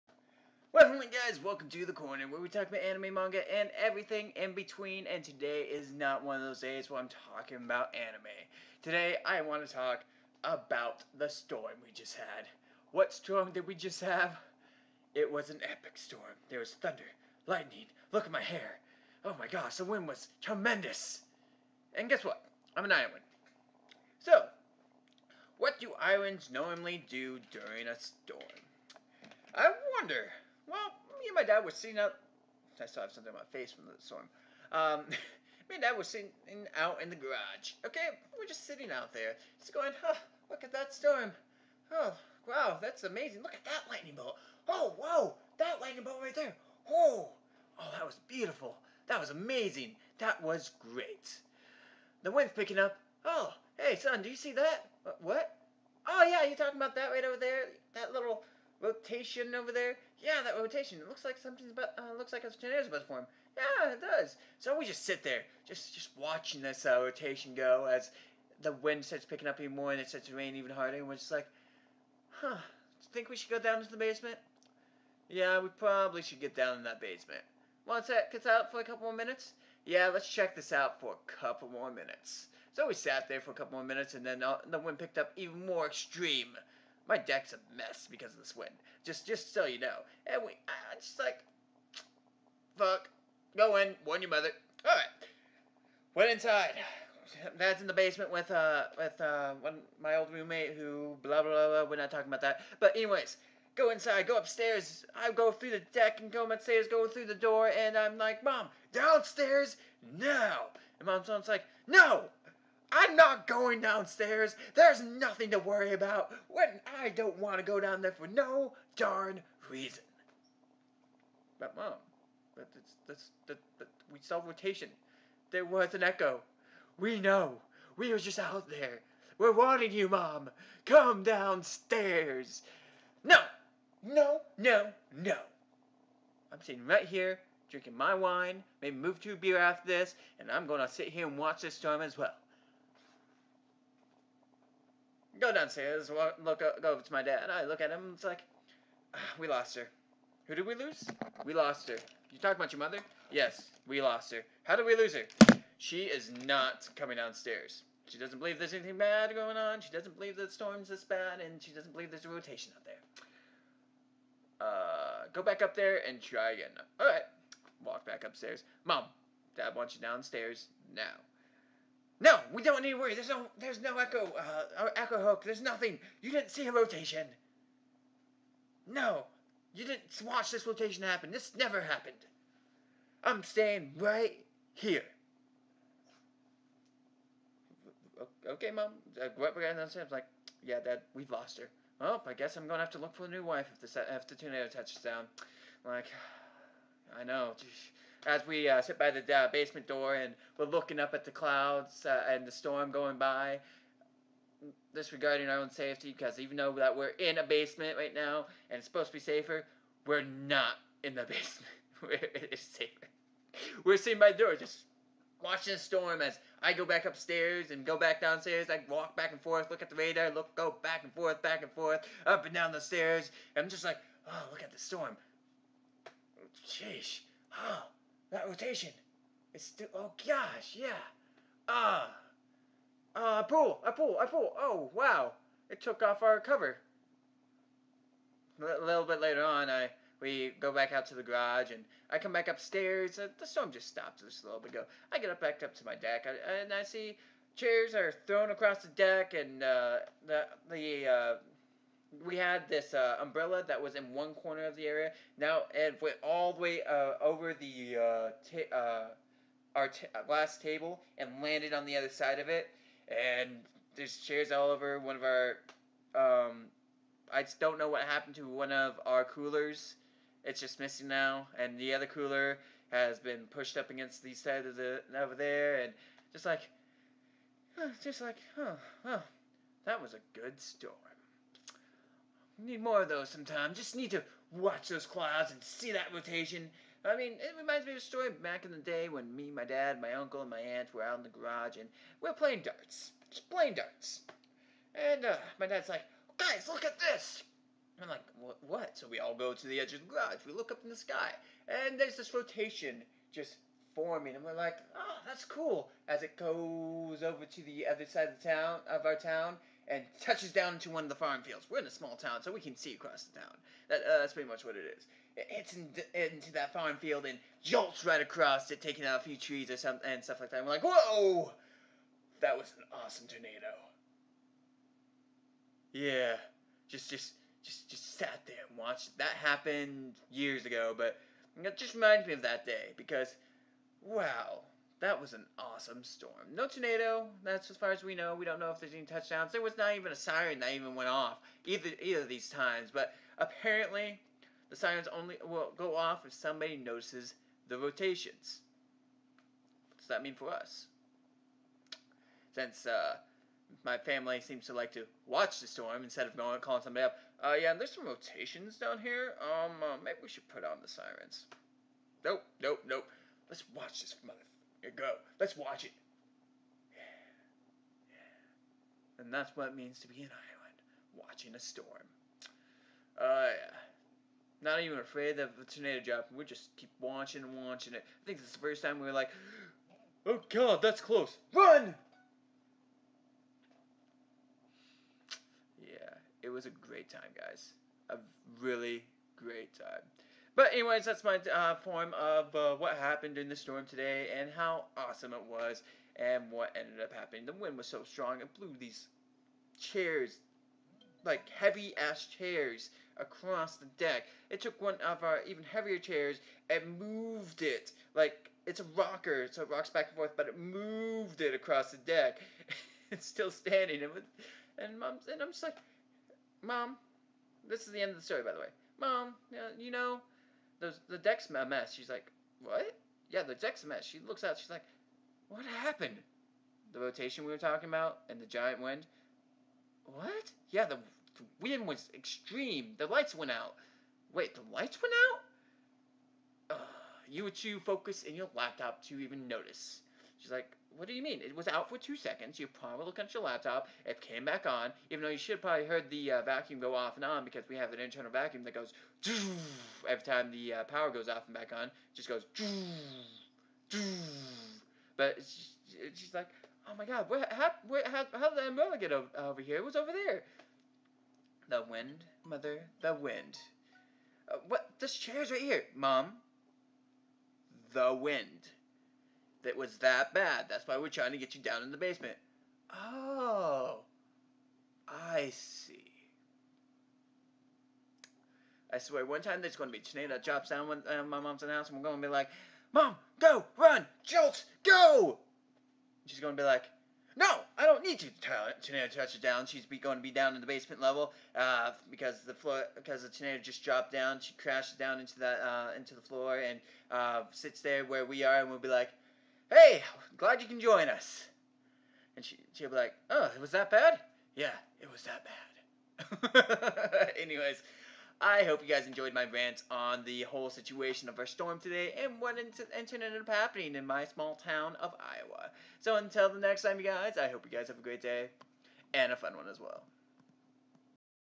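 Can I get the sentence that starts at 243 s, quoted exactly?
Uh, the storm just stopped just a little bit ago.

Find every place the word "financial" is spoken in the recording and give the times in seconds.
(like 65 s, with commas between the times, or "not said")
not said.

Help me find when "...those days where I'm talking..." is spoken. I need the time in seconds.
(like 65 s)
6 s.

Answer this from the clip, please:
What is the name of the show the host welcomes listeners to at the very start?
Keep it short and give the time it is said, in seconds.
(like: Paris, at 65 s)
The Corner, at 1 s.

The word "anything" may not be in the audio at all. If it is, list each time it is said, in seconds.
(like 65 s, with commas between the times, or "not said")
158 s.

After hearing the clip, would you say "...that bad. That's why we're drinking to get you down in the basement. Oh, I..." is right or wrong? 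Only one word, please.
wrong.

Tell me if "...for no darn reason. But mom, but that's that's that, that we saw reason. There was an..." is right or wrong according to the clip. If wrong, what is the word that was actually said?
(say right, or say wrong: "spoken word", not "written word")
wrong: "rotation", not "reason".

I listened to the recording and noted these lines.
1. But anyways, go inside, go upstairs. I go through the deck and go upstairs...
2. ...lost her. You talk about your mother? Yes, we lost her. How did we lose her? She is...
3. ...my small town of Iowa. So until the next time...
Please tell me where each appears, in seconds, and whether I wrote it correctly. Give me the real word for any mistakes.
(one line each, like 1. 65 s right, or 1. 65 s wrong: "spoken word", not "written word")
1. 102 s right
2. 151 s right
3. 514 s right.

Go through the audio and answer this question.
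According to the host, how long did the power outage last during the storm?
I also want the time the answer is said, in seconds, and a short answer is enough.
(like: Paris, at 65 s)
2 seconds, at 441 s.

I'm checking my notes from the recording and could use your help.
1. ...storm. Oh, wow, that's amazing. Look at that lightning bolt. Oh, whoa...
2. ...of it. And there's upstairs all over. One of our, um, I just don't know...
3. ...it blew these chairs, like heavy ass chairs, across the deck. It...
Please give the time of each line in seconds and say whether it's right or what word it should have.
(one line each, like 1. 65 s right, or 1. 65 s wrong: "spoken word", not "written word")
1. 40 s right
2. 262 s wrong: "chairs", not "upstairs"
3. 398 s right.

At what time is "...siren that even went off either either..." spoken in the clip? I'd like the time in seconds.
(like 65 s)
340 s.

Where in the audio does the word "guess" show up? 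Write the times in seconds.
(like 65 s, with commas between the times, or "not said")
22 s, 192 s.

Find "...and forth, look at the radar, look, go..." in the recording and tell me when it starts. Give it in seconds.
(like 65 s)
219 s.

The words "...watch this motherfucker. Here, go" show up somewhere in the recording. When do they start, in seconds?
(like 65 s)
363 s.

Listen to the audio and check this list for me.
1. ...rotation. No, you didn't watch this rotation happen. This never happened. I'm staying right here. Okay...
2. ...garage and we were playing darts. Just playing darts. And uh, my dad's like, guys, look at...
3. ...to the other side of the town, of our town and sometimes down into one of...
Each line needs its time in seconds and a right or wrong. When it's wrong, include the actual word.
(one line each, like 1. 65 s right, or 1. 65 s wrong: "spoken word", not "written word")
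1. 176 s right
2. 291 s right
3. 307 s wrong: "touches", not "sometimes".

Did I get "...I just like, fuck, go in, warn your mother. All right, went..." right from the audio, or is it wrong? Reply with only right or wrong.
right.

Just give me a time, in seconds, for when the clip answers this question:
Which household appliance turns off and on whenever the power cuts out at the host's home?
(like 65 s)
447 s.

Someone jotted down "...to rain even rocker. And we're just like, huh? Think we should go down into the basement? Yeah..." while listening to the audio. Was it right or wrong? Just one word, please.
wrong.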